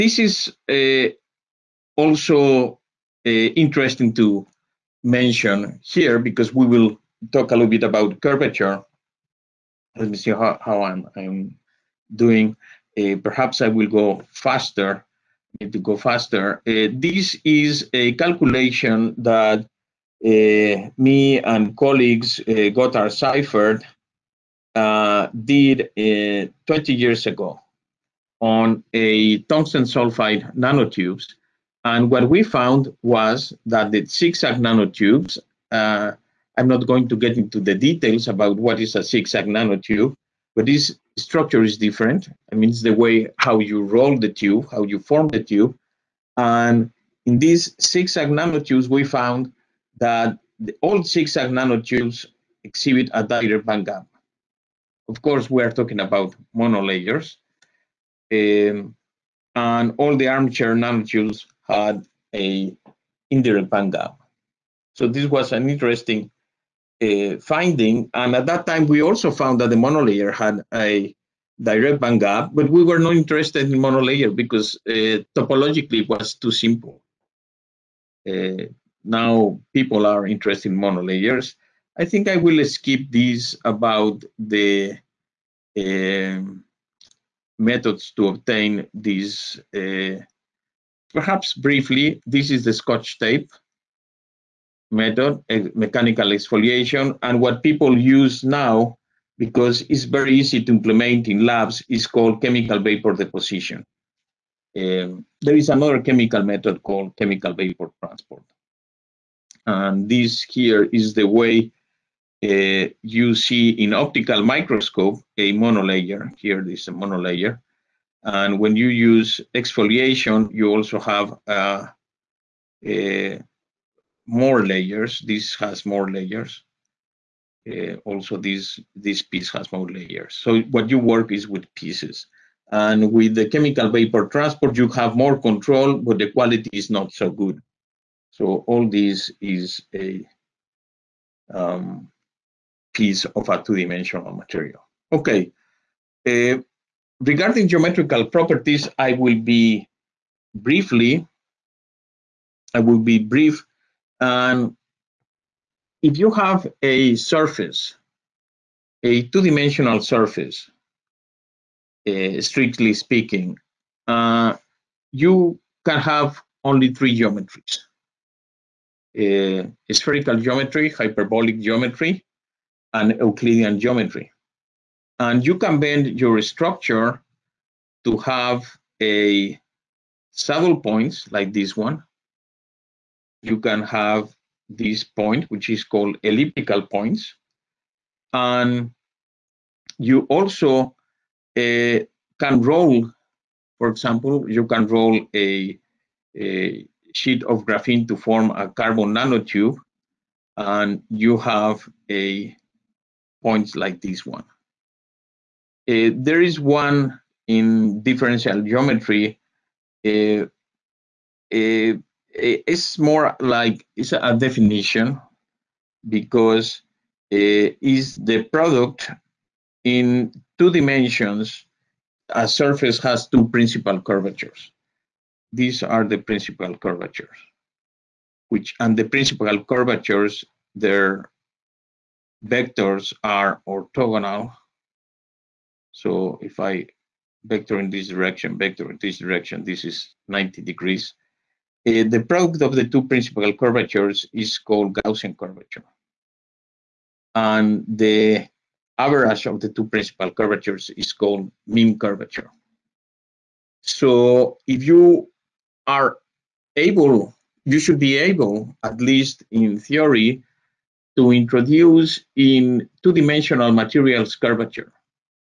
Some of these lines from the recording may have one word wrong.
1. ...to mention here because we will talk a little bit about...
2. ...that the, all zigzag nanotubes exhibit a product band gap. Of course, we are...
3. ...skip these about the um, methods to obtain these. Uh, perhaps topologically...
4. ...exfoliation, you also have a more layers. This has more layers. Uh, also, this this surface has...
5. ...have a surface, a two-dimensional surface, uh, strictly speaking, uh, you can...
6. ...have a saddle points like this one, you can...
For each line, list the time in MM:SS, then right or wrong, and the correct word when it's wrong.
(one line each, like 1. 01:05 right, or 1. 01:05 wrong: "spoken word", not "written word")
1. 00:04 right
2. 00:50 wrong: "direct", not "product"
3. 01:22 wrong: "briefly", not "topologically"
4. 01:59 wrong: "piece", not "surface"
5. 02:36 right
6. 02:58 right.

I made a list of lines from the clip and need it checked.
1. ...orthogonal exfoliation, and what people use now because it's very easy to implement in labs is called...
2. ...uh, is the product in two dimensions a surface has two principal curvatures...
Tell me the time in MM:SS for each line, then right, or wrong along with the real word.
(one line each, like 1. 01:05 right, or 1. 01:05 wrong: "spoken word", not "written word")
1. 01:35 wrong: "mechanical", not "orthogonal"
2. 03:37 right.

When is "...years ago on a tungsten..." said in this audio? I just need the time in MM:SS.
00:26.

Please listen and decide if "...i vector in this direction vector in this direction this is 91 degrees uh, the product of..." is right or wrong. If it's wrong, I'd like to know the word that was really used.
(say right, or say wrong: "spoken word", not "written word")
wrong: "90", not "91".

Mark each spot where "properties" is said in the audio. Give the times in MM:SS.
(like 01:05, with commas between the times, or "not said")
02:28.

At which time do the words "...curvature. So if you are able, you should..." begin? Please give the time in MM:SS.
04:11.